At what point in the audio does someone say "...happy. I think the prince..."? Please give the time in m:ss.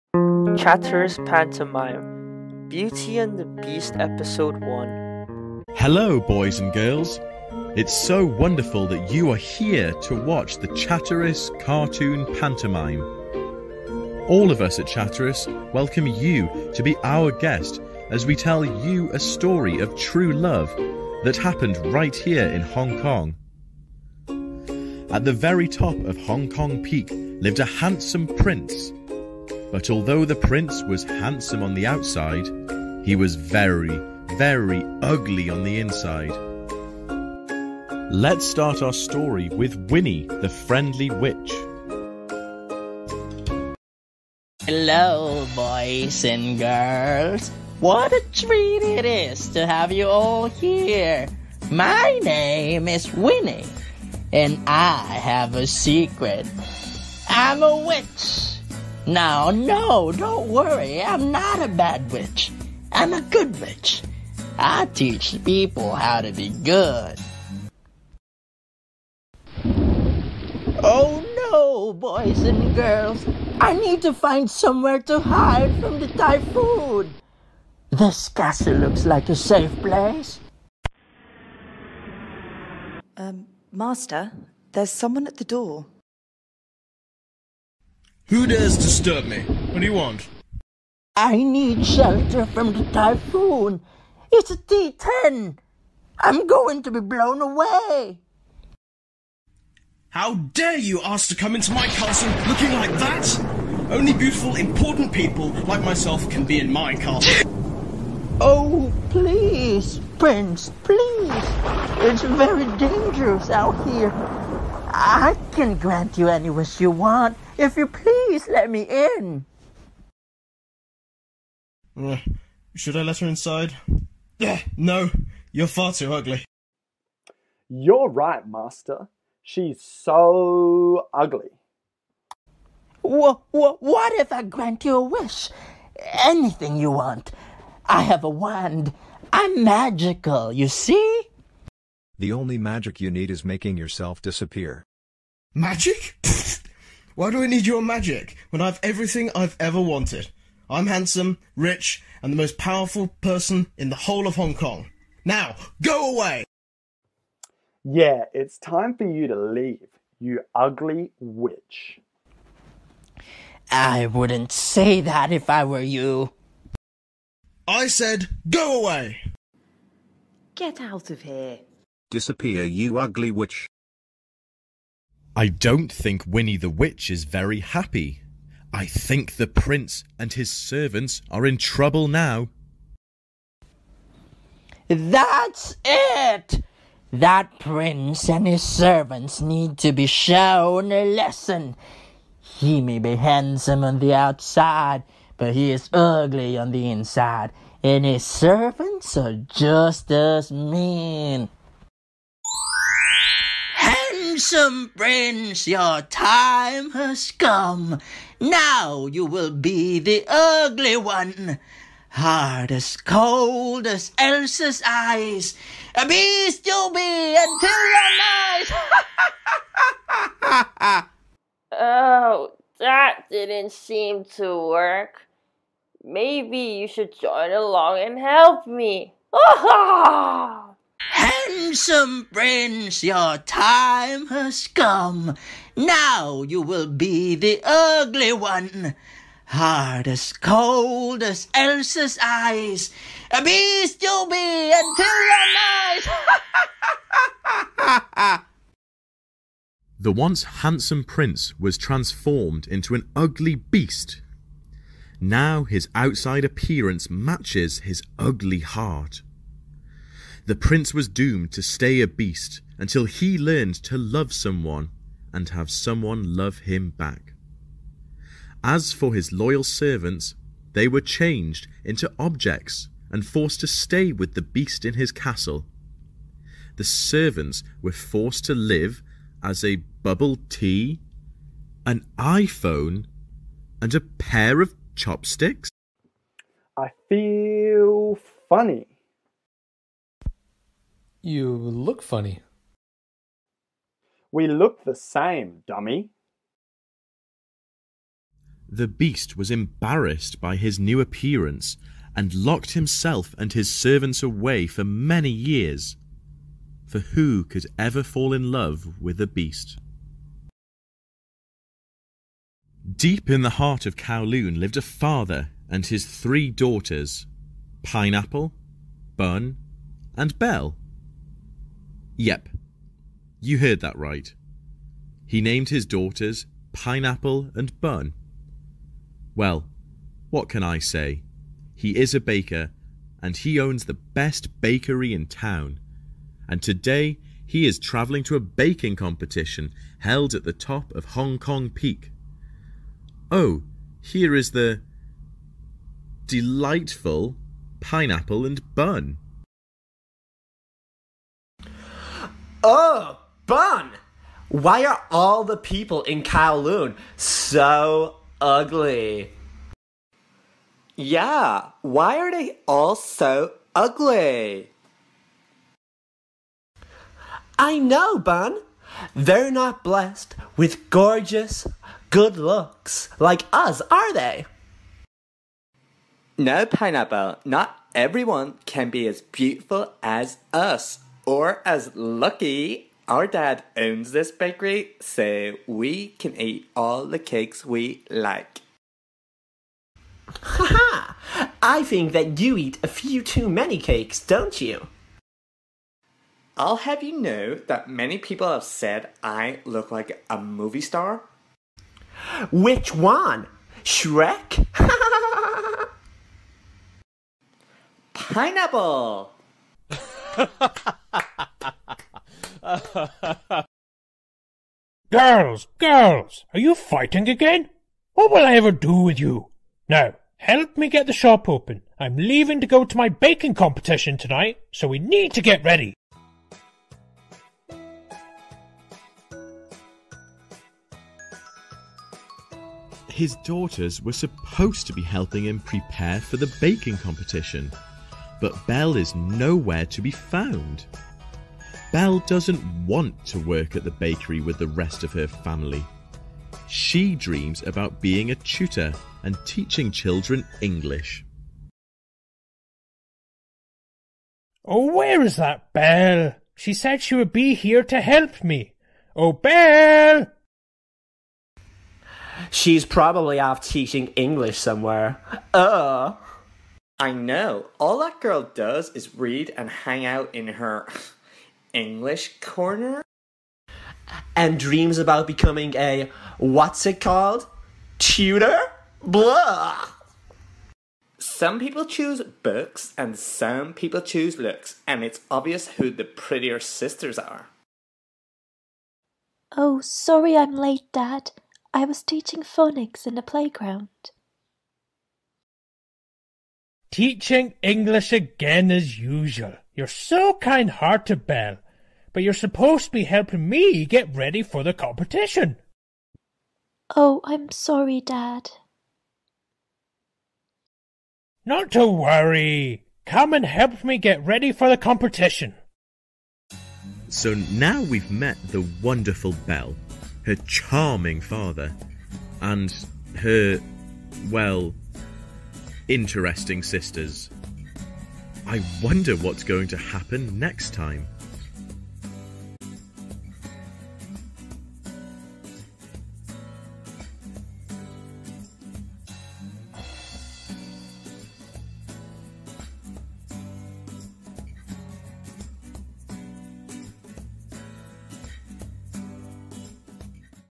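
2:57.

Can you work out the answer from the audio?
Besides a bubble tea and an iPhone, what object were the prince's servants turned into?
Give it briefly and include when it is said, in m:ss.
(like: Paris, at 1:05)
A pair of chopsticks, at 4:43.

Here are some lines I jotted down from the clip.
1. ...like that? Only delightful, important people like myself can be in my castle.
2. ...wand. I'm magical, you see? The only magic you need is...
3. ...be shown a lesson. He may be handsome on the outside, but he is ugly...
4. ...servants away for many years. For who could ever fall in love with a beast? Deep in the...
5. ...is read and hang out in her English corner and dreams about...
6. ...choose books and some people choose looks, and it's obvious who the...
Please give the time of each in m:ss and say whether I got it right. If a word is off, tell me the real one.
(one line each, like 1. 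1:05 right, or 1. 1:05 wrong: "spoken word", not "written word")
1. 1:42 wrong: "beautiful", not "delightful"
2. 2:18 right
3. 3:09 right
4. 5:03 right
5. 7:48 right
6. 8:01 right.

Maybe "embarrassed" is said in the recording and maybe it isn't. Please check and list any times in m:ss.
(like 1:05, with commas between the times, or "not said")
4:59.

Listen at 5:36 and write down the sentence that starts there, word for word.
And today he is travelling to a baking competition held at the top of Hong Kong Peak.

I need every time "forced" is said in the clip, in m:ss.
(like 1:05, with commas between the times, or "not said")
4:33, 4:37.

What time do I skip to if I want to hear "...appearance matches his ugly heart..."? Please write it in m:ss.
4:16.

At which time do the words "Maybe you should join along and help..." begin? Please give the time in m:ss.
3:46.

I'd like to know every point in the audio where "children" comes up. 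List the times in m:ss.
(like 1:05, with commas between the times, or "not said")
7:29.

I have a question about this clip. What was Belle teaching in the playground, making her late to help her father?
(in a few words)
Phonics.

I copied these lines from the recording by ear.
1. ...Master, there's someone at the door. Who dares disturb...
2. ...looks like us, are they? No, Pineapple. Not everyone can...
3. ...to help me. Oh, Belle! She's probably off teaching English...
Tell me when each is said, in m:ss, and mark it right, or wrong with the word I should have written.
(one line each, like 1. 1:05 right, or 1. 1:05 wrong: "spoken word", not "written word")
1. 1:23 right
2. 6:12 right
3. 7:37 right.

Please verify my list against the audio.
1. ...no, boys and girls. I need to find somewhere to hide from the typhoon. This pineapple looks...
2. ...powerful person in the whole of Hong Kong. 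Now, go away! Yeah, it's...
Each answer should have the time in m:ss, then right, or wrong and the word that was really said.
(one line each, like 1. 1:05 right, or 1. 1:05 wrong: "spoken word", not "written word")
1. 1:11 wrong: "castle", not "pineapple"
2. 2:32 right.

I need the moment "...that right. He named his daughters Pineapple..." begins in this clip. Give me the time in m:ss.
5:23.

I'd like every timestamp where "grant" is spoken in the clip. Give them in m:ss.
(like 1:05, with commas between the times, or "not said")
1:55, 2:14.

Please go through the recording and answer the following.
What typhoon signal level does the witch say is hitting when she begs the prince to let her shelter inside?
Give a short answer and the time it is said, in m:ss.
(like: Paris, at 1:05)
T-10, at 1:34.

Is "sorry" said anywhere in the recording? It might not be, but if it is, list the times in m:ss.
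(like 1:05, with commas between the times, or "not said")
8:09, 8:27.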